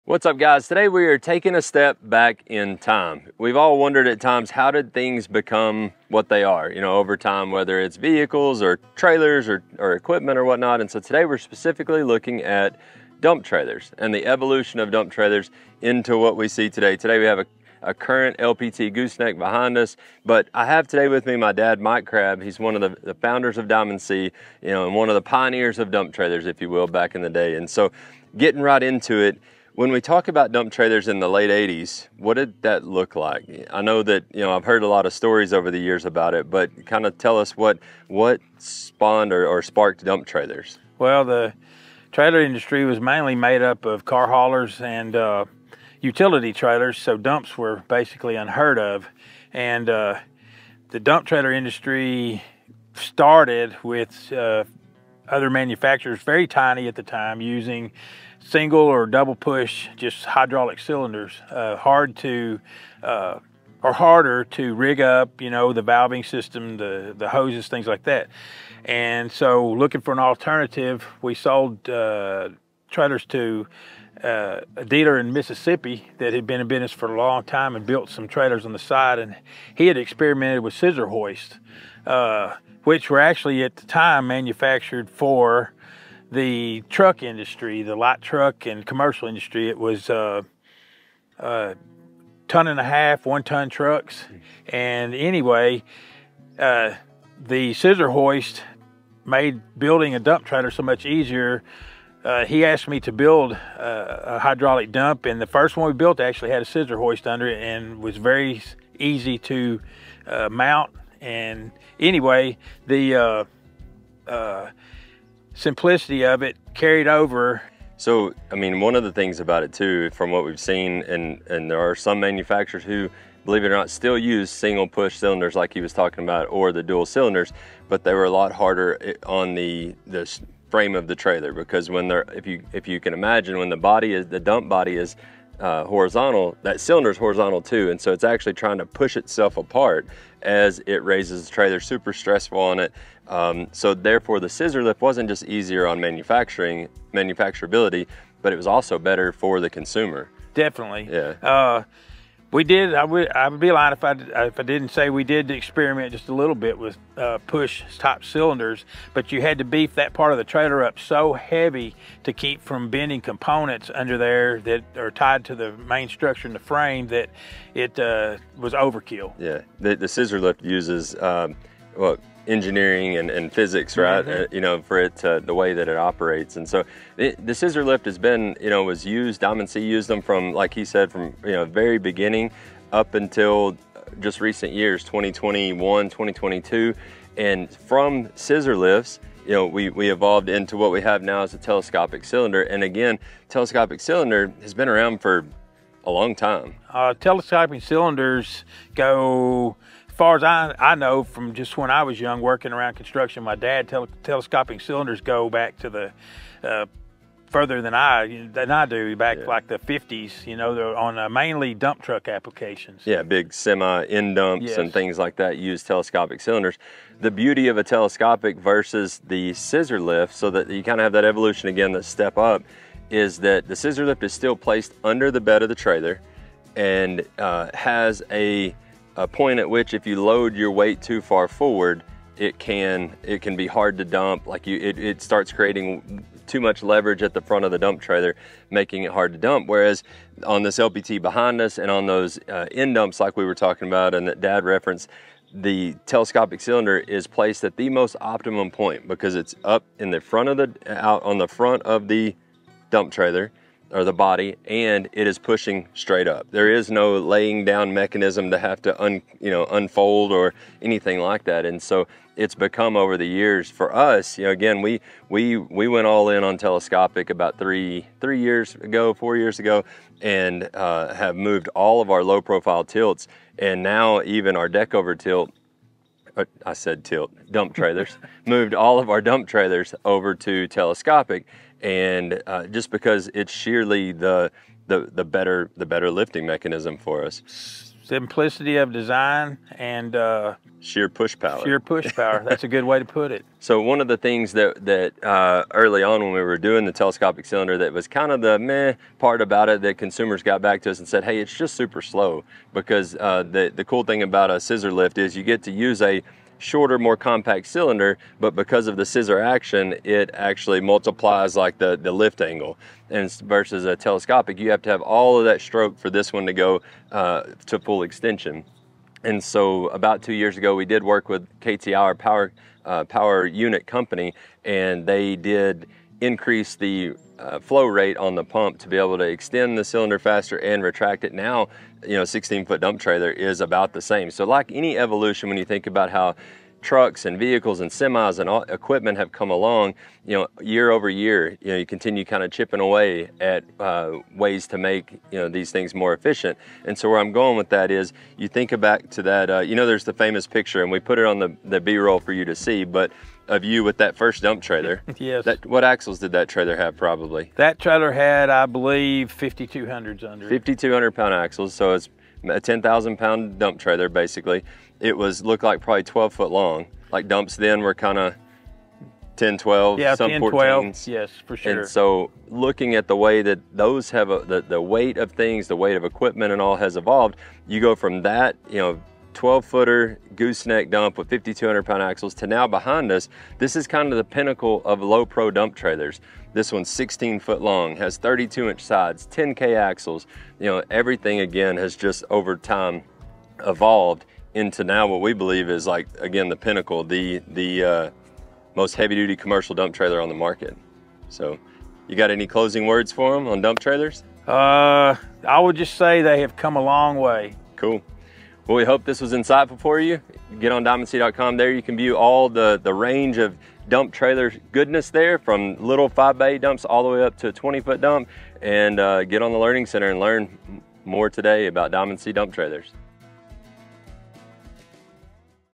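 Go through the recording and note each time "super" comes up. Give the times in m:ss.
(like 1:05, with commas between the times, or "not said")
2:21, 5:01.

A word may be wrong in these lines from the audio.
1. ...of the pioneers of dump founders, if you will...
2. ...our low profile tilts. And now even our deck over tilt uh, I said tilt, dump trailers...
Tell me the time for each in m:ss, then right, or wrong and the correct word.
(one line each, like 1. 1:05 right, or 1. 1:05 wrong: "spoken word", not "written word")
1. 0:25 wrong: "trailers", not "founders"
2. 4:32 right.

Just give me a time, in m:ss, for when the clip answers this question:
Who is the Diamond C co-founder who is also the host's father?
0:21.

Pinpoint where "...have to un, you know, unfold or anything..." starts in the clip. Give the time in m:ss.
4:18.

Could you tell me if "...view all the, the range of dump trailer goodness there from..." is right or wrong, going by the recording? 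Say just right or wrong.
right.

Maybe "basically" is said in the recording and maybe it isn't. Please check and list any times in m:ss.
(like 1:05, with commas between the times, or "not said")
0:47, 6:04.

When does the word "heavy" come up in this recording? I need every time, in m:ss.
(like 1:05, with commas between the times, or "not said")
2:41, 6:38.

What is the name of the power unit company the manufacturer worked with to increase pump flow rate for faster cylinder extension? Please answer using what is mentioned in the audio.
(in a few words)
KTI.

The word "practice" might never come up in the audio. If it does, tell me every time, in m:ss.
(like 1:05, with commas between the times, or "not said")
not said.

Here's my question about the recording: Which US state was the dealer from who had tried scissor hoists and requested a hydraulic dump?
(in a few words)
Mississippi.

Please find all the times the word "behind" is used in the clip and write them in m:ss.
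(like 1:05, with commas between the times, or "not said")
0:19, 4:01, 6:22.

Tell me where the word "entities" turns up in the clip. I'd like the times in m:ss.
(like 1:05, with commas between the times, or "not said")
not said.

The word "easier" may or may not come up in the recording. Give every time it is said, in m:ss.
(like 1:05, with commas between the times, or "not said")
1:41, 2:25.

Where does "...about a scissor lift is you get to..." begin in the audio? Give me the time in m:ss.
5:04.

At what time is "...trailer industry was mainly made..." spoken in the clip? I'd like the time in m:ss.
0:42.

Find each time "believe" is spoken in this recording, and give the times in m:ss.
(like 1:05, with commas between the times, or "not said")
2:03, 5:58, 6:35.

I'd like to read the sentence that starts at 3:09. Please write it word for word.
You know, we, we evolved into what we have now as a telescopic cylinder.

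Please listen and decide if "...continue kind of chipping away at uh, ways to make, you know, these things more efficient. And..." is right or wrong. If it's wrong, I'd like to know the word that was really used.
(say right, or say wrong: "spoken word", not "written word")
right.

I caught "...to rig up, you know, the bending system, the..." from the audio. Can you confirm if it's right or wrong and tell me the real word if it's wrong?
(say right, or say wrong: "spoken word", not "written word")
wrong: "valving", not "bending".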